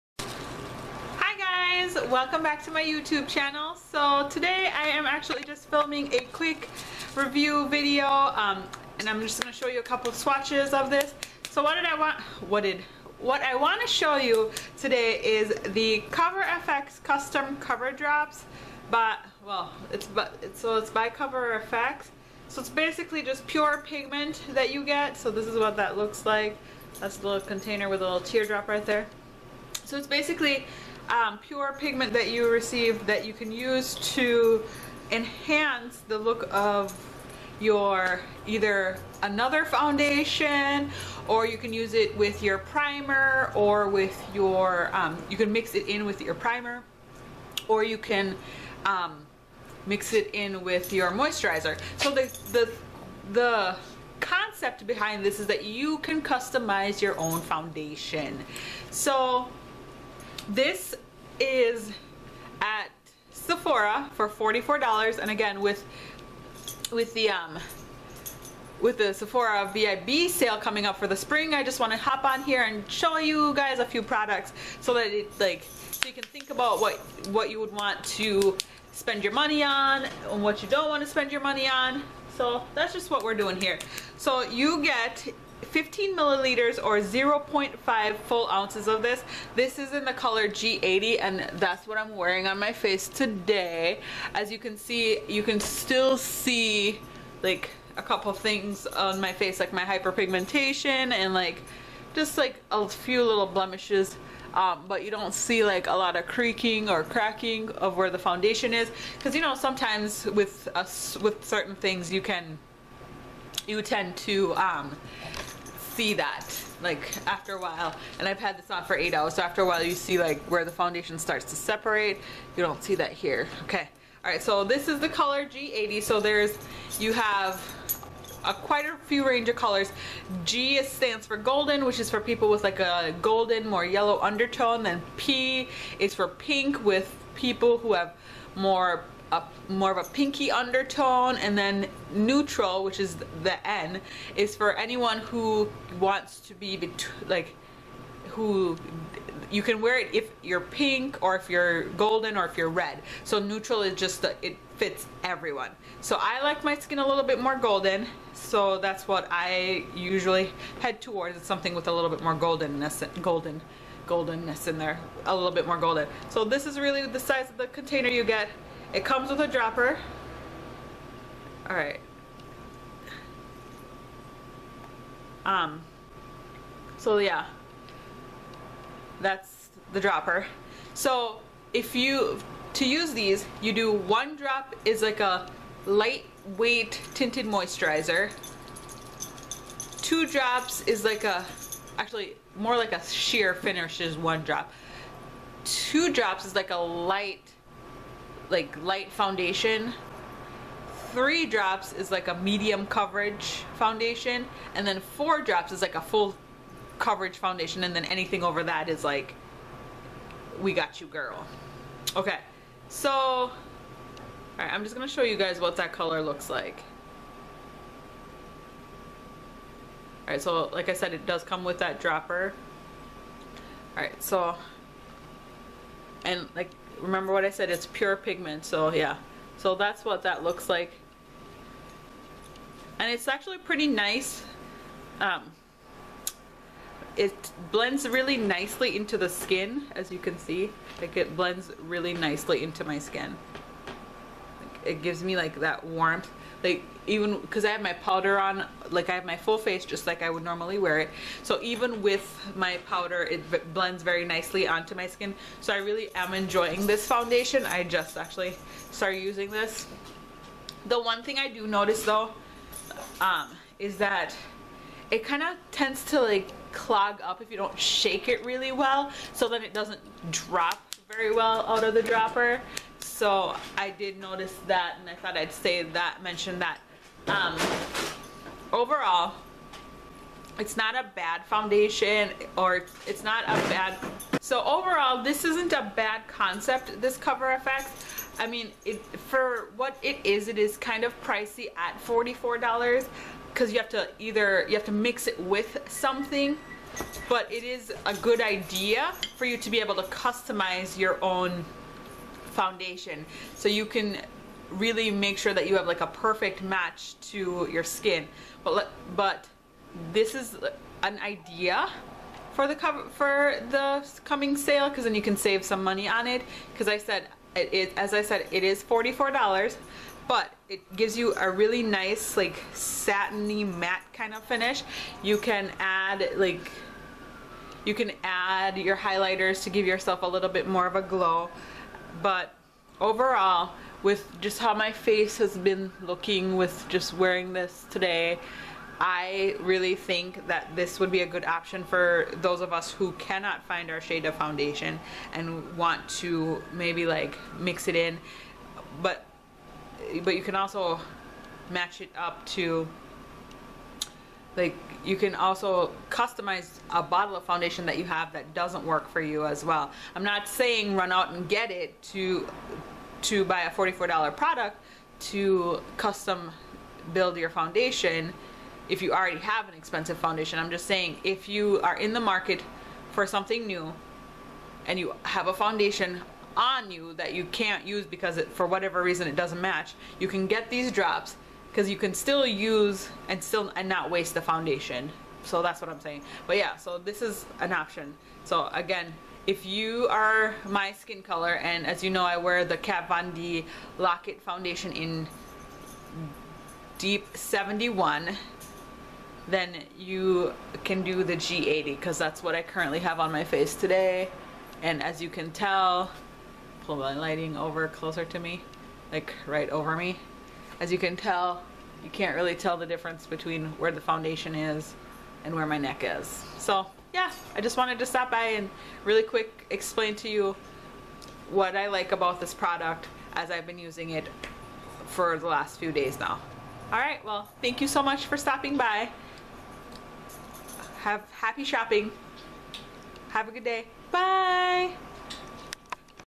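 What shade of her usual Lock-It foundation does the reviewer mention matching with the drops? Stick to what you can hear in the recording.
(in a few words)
deep 71.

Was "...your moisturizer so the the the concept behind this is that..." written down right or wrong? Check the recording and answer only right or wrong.
right.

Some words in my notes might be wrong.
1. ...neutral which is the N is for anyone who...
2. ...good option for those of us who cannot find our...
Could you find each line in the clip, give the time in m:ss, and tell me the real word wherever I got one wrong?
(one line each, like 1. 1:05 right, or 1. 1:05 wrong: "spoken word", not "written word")
1. 2:22 right
2. 5:41 right.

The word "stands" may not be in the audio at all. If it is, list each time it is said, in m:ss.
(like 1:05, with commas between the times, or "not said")
2:10.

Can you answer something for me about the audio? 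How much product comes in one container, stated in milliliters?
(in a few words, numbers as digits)
15 milliliters.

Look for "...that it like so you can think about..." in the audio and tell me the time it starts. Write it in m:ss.
1:14.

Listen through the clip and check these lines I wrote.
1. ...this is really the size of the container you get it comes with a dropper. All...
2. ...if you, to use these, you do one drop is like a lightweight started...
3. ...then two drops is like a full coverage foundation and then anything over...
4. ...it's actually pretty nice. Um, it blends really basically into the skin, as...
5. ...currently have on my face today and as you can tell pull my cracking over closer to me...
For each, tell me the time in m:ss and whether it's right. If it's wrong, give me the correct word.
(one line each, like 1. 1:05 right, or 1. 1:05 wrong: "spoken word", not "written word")
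1. 2:46 right
2. 3:01 wrong: "tinted", not "started"
3. 3:24 wrong: "four", not "two"
4. 3:53 wrong: "nicely", not "basically"
5. 6:42 wrong: "lighting", not "cracking".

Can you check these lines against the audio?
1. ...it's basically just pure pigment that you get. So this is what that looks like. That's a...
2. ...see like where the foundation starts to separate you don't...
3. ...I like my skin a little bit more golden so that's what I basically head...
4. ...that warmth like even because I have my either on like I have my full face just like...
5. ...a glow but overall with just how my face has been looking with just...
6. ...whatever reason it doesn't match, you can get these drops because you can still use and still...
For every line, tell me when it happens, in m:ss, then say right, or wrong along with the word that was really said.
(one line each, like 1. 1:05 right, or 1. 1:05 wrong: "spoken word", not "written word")
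1. 0:22 right
2. 1:59 right
3. 2:36 wrong: "usually", not "basically"
4. 4:05 wrong: "powder", not "either"
5. 5:30 right
6. 6:18 right.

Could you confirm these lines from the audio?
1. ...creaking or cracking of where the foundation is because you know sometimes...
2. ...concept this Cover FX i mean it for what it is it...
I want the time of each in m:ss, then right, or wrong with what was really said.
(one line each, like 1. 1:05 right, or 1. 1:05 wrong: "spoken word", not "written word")
1. 1:46 right
2. 4:46 right.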